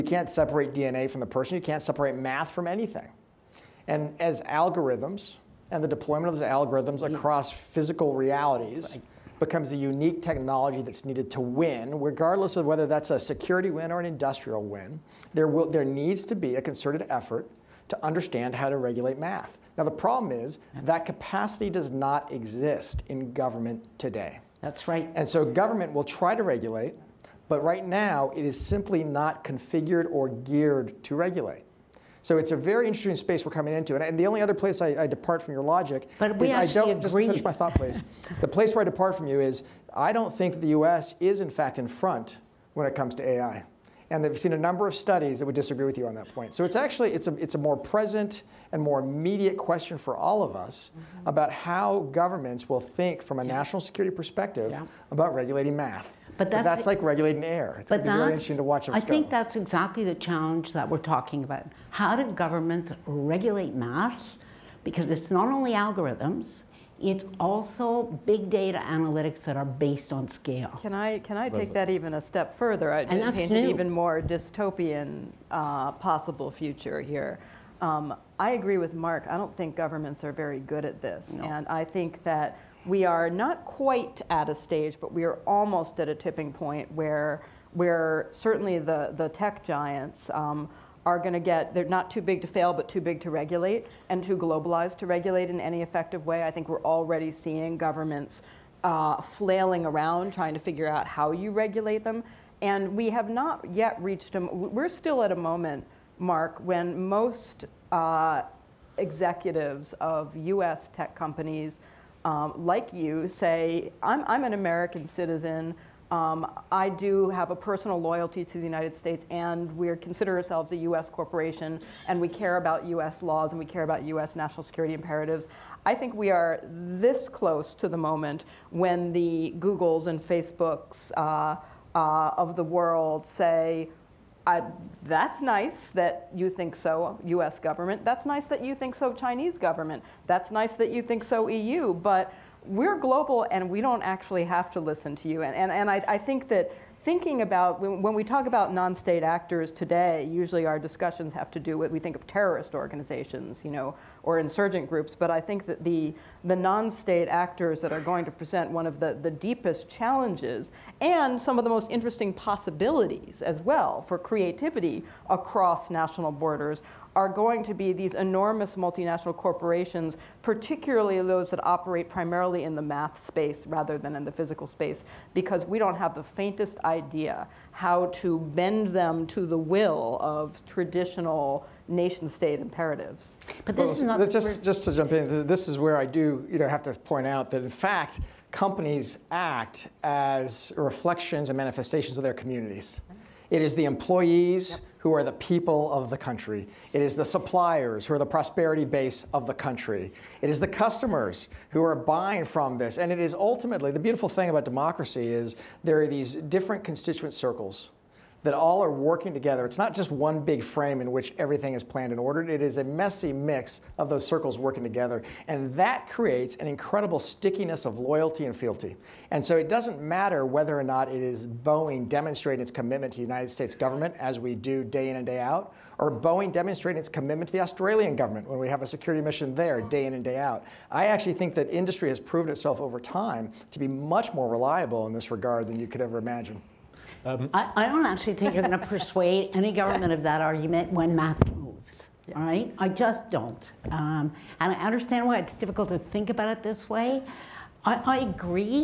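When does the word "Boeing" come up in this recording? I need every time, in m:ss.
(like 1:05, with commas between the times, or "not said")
3:41, 3:46.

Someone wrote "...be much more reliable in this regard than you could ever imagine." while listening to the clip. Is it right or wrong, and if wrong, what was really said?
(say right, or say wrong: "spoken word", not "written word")
right.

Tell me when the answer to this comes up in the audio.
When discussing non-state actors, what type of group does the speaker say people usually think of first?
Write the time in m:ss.
2:32.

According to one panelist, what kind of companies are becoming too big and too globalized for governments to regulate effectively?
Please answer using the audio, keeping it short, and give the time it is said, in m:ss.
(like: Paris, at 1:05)
tech giants, at 1:29.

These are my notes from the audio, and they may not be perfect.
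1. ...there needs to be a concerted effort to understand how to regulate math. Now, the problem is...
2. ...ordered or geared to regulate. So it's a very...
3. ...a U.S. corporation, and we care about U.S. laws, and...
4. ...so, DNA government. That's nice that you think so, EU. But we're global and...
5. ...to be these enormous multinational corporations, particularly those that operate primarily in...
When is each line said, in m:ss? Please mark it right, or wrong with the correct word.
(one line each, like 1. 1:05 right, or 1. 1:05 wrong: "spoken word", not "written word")
1. 0:15 right
2. 0:29 wrong: "configured", not "ordered"
3. 2:00 right
4. 2:18 wrong: "Chinese", not "DNA"
5. 2:47 right.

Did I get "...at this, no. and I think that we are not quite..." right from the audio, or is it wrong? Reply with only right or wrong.
right.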